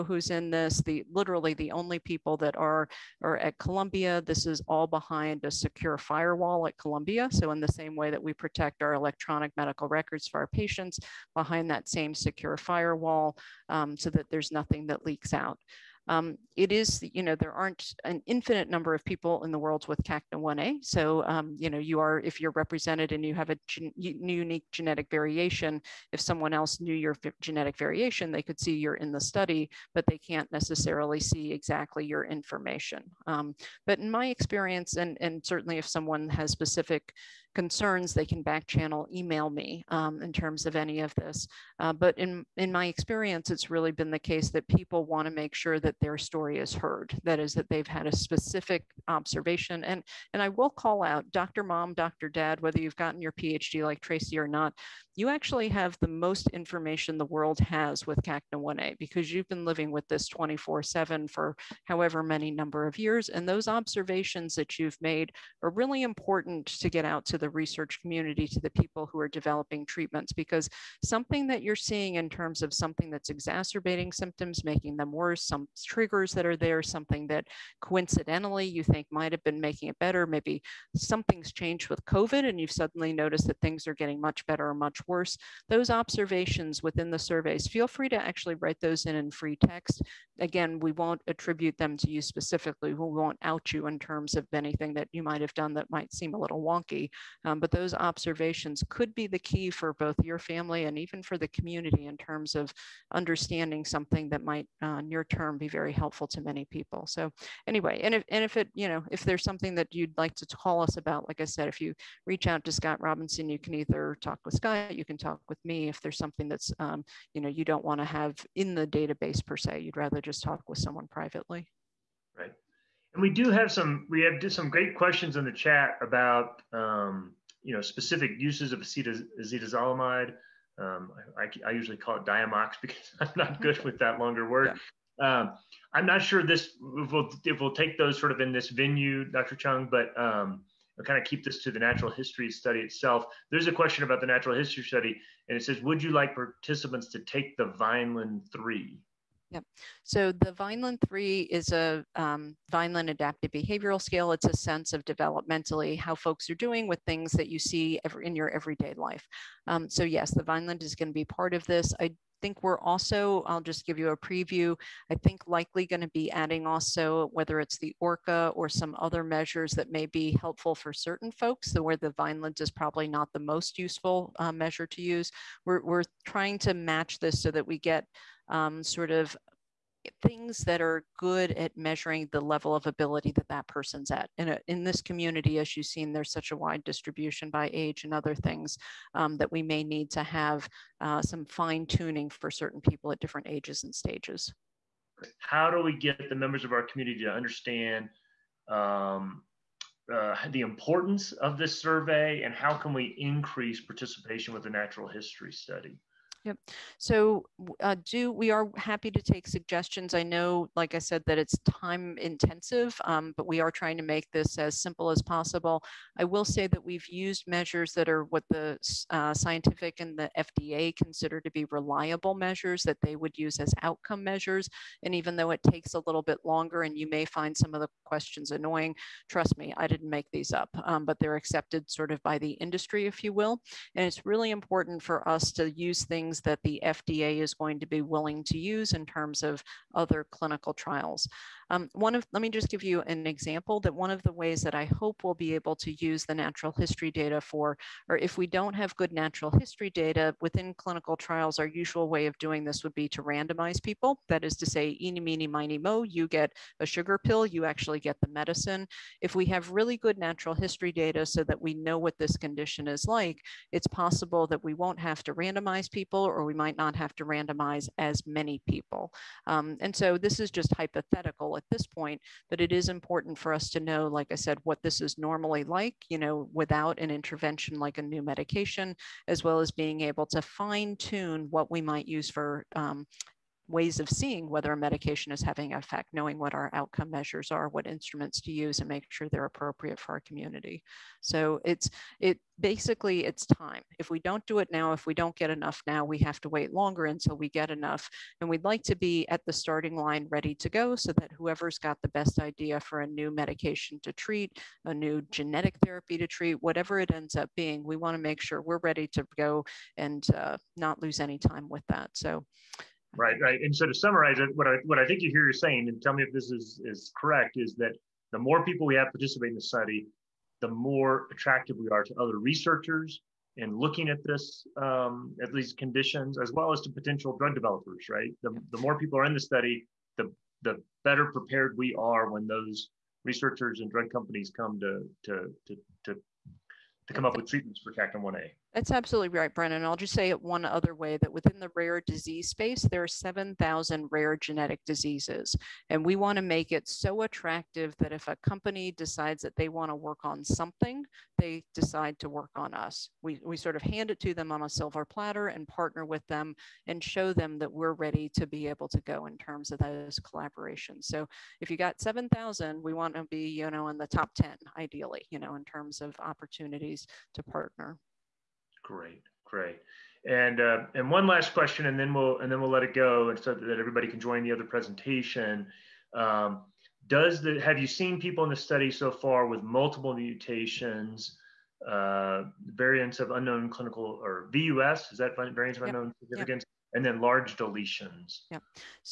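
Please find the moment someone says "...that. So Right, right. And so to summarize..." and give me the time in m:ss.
5:11.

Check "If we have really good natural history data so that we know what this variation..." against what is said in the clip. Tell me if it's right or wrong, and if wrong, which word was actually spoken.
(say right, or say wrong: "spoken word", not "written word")
wrong: "condition", not "variation".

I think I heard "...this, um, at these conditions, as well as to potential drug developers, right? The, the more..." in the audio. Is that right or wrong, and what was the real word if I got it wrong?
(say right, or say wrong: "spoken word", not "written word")
right.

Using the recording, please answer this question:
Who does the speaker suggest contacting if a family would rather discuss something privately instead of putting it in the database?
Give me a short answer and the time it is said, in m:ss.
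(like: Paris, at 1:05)
Scott Robinson, at 1:52.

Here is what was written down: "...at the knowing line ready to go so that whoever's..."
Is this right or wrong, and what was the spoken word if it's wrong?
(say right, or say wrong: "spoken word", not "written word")
wrong: "starting", not "knowing".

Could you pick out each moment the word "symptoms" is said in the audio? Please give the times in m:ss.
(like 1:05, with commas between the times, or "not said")
1:14.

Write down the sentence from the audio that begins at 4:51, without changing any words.
So it's it basically it's time.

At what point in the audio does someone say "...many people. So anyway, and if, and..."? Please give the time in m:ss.
1:46.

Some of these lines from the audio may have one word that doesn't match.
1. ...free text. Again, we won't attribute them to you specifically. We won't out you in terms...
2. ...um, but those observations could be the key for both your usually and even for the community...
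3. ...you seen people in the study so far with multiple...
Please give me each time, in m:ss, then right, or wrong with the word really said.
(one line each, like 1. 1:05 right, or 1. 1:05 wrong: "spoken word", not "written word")
1. 1:29 right
2. 1:37 wrong: "family", not "usually"
3. 6:17 right.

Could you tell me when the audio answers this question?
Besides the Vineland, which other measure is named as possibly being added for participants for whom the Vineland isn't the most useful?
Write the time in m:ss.
2:48.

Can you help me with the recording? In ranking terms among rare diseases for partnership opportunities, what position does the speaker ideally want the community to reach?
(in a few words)
top 10.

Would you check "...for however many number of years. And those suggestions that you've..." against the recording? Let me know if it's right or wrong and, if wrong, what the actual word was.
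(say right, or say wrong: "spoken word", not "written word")
wrong: "observations", not "suggestions".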